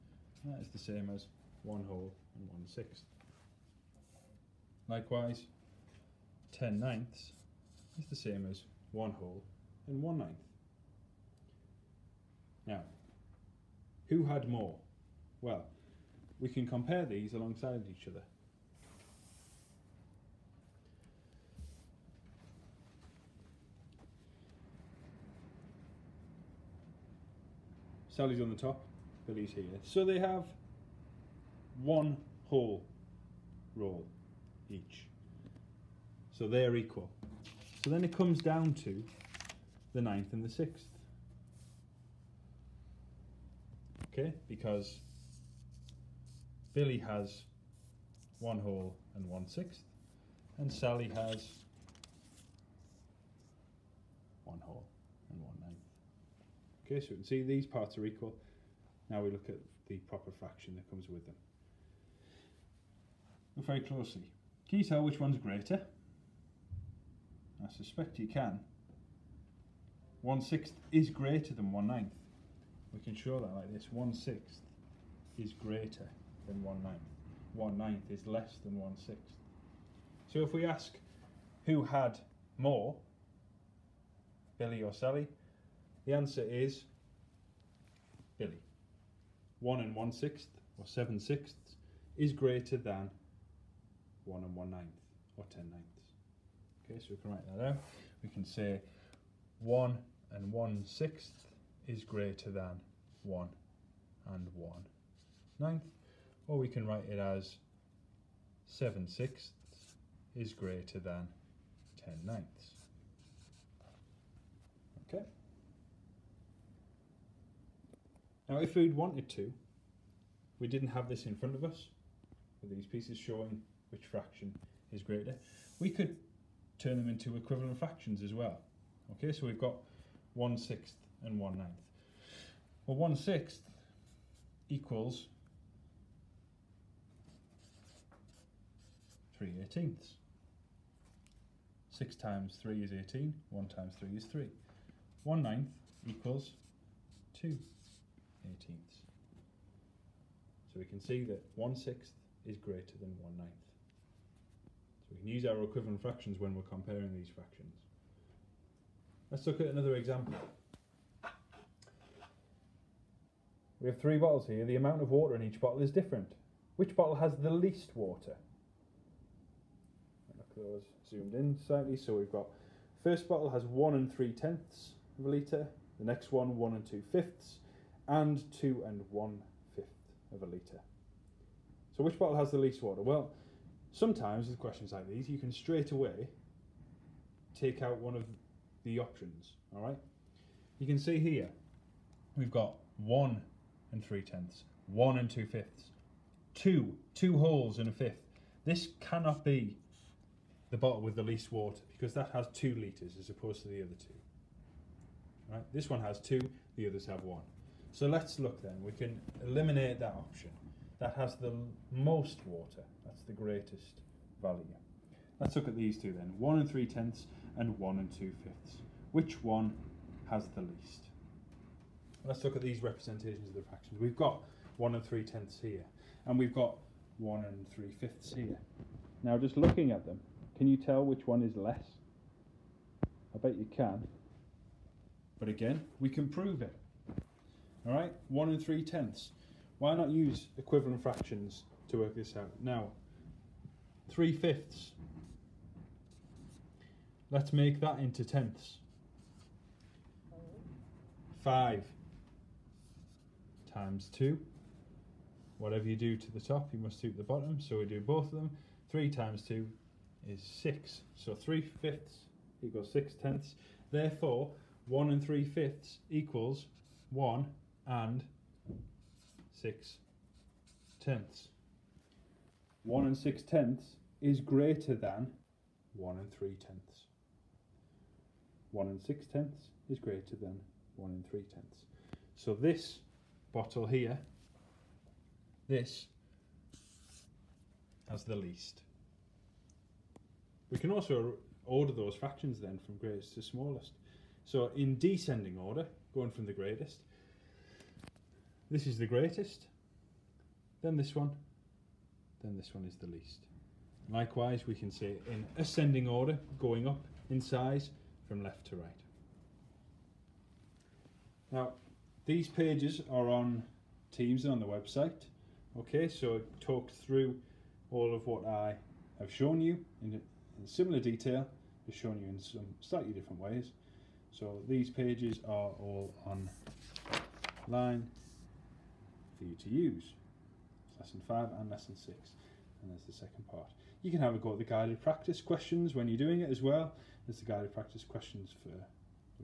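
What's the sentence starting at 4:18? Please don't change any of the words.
3 times 2 is 6, so 3 fifths equals 6 tenths.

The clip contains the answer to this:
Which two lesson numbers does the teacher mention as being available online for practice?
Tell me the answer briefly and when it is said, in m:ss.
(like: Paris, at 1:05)
Lesson 5 and Lesson 6, at 5:30.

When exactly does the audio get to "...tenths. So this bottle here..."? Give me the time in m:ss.
4:41.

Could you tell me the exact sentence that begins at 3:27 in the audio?
So let's look then, we can eliminate that option.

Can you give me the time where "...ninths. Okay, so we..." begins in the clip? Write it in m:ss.
1:35.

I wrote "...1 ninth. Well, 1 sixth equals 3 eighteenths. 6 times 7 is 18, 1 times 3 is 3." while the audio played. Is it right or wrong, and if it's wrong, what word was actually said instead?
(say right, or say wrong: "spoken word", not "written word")
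wrong: "3", not "7".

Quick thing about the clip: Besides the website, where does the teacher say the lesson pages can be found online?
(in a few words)
Teams.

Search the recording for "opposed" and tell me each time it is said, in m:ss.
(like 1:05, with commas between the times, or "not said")
3:23.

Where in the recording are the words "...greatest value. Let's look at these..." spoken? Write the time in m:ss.
3:33.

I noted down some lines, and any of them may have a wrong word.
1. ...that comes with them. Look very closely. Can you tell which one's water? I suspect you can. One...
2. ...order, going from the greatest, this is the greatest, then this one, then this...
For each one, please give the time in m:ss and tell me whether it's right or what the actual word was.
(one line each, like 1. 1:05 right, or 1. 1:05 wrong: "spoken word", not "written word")
1. 1:00 wrong: "greater", not "water"
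2. 4:55 right.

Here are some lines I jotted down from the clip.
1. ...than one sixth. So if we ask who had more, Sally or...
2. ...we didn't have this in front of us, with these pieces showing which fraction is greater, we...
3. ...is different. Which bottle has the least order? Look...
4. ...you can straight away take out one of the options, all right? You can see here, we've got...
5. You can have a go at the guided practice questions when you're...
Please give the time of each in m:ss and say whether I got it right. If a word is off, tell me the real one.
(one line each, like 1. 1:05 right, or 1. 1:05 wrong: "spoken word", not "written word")
1. 1:18 wrong: "Billy", not "Sally"
2. 2:00 right
3. 2:45 wrong: "water", not "order"
4. 3:05 right
5. 5:34 right.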